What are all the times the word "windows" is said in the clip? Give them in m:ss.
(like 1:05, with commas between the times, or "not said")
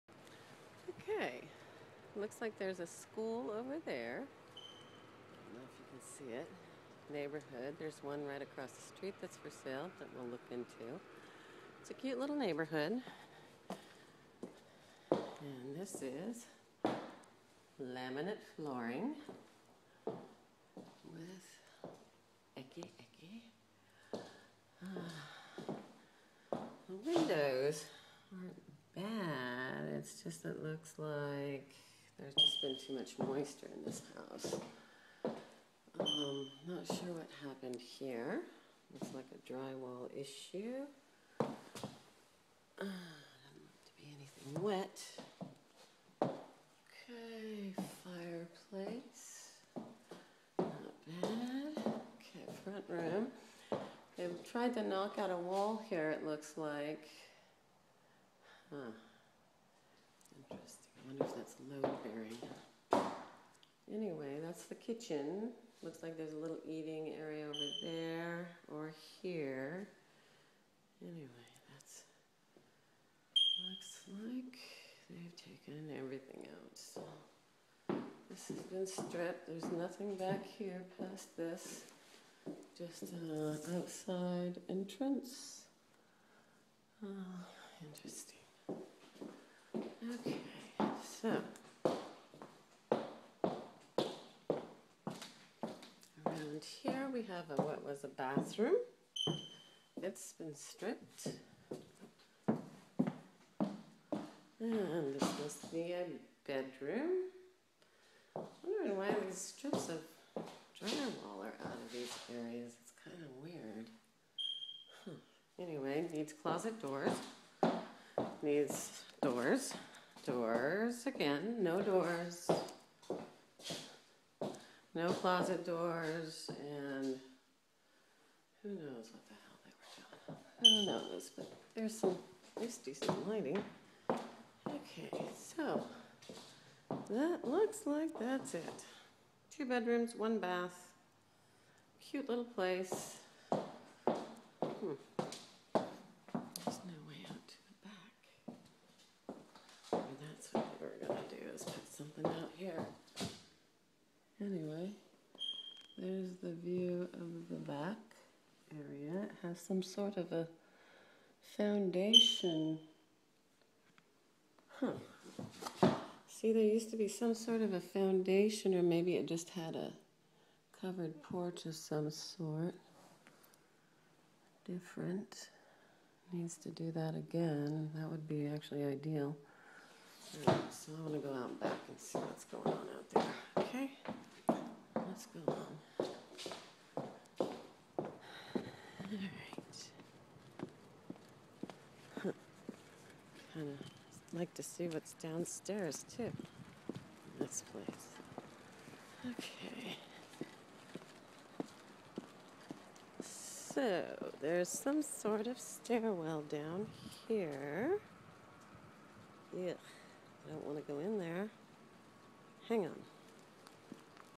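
0:27.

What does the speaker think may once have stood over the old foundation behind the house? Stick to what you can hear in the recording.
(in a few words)
A covered porch.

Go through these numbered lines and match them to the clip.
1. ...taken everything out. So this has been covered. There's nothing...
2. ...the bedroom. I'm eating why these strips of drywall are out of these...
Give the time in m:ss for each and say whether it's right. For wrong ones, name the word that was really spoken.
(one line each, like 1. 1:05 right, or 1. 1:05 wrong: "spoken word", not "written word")
1. 1:15 wrong: "stripped", not "covered"
2. 1:45 wrong: "wondering", not "eating".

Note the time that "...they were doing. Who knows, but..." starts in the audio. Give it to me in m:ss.
2:09.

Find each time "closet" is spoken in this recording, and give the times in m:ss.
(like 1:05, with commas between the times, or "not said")
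1:56, 2:05.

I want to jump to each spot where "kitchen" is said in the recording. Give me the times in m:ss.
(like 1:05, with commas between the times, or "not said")
1:04.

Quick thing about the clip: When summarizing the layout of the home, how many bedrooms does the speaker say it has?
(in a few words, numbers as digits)
2.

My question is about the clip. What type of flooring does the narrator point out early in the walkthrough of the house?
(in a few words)
Laminate flooring.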